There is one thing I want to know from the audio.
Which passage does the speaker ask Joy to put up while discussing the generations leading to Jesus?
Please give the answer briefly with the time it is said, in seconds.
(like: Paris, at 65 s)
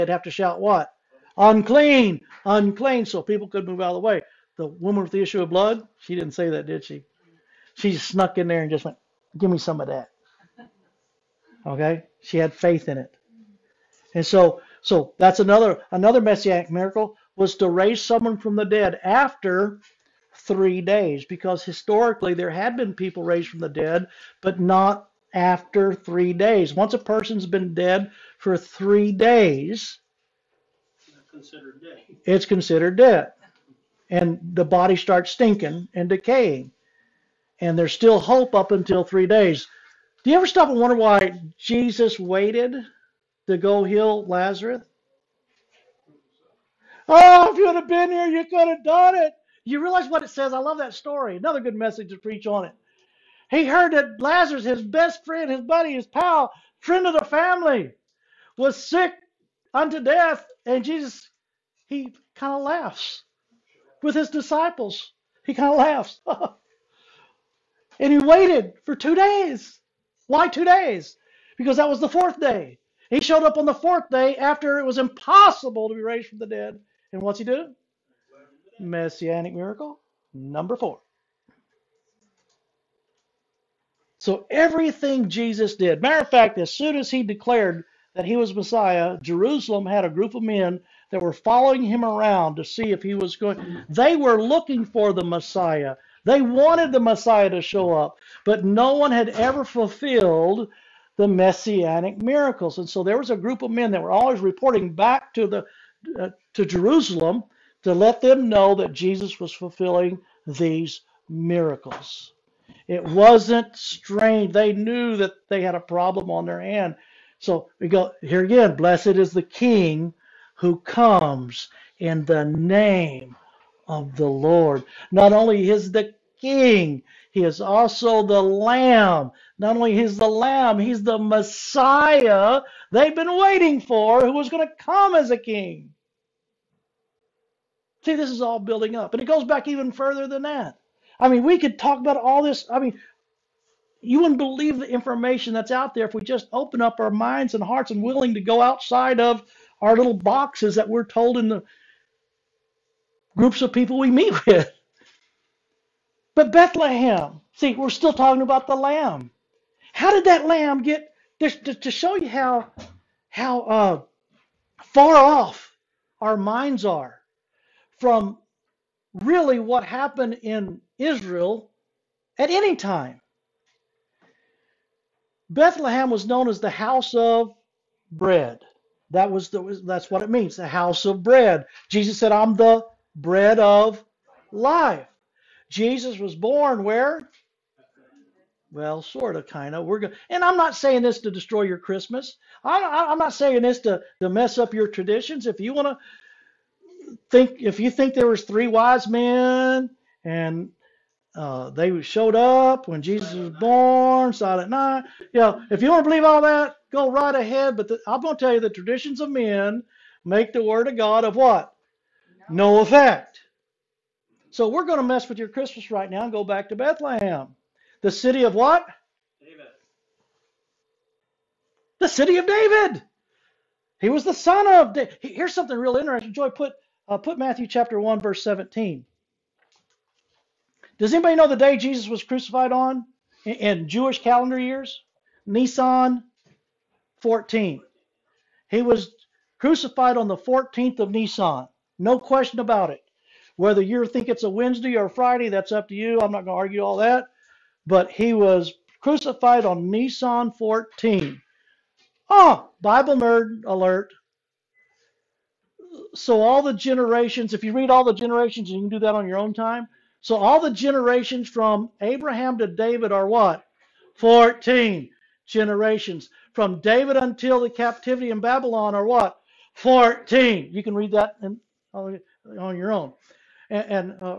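Matthew 1:17, at 227 s.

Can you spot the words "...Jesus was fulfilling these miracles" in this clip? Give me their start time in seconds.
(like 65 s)
108 s.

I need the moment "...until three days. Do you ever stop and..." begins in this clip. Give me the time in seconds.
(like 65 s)
38 s.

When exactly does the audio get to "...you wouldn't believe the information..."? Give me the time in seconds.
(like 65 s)
144 s.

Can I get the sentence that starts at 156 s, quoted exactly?
But Bethlehem, see, we're still talking about the lamb.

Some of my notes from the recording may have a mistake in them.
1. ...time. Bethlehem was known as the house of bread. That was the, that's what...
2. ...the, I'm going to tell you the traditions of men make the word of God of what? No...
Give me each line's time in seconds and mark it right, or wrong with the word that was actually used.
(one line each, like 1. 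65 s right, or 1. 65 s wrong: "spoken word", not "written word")
1. 172 s right
2. 207 s right.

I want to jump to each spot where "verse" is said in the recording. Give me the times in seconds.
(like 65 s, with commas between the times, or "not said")
228 s.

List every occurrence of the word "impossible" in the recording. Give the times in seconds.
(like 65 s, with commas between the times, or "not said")
74 s.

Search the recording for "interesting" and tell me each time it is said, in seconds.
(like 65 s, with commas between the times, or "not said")
225 s.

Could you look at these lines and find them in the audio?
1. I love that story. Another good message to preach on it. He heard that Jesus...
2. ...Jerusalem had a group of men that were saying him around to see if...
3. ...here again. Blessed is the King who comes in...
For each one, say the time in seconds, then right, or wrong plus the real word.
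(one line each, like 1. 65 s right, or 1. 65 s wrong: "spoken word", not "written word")
1. 50 s wrong: "Lazarus", not "Jesus"
2. 89 s wrong: "following", not "saying"
3. 118 s right.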